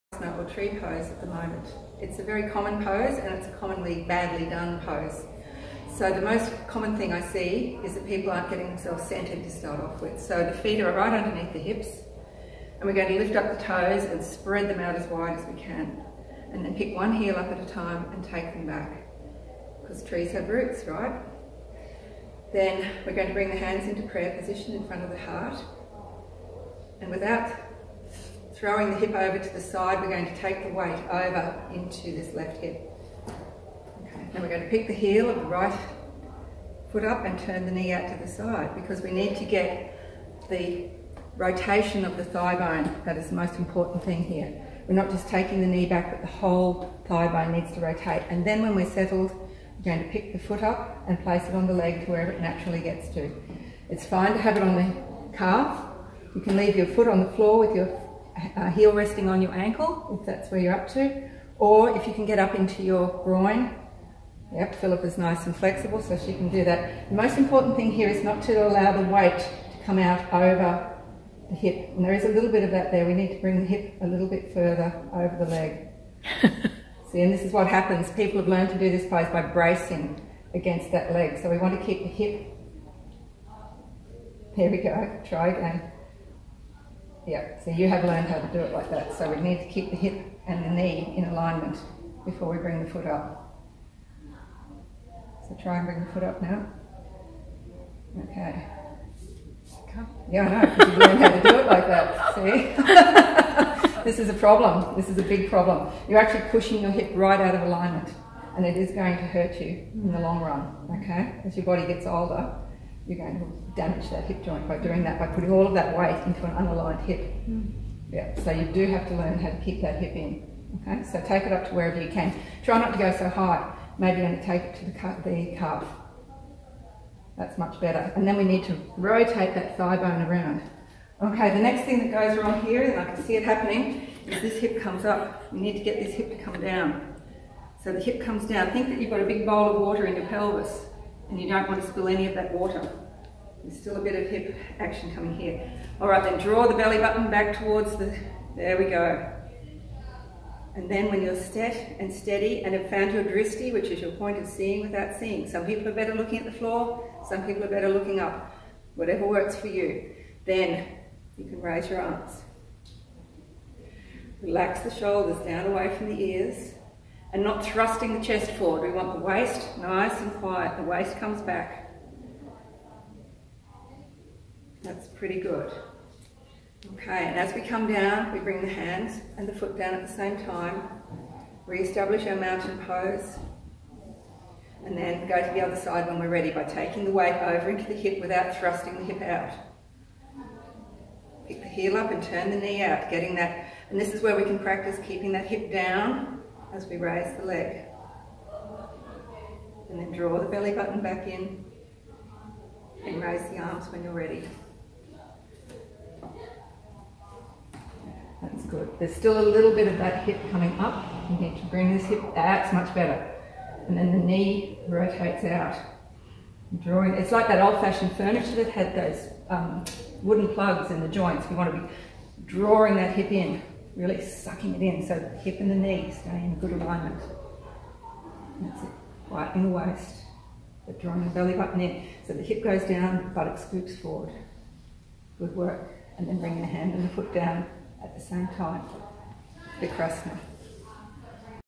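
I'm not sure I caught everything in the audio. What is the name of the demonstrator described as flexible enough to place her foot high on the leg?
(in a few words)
Philip.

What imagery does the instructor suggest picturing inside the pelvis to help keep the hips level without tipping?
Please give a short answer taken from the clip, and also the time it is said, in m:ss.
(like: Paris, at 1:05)
A big bowl of water, at 2:19.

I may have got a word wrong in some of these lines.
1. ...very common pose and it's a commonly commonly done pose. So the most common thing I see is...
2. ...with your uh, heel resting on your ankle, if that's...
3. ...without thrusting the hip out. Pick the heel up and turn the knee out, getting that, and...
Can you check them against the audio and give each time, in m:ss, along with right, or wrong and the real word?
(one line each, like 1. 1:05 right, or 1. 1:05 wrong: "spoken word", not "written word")
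1. 0:02 wrong: "badly", not "commonly"
2. 0:57 right
3. 3:08 right.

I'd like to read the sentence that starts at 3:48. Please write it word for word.
That's it, right in the waist, but drawing the belly button in.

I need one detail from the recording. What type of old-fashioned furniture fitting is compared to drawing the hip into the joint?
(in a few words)
Wooden plugs.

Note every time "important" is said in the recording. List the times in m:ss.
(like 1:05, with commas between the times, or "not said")
0:43, 1:07.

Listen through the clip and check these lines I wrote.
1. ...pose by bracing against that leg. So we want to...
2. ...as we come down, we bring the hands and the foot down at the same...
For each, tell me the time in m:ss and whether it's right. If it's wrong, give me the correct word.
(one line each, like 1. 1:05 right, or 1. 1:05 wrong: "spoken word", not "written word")
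1. 1:19 right
2. 2:57 right.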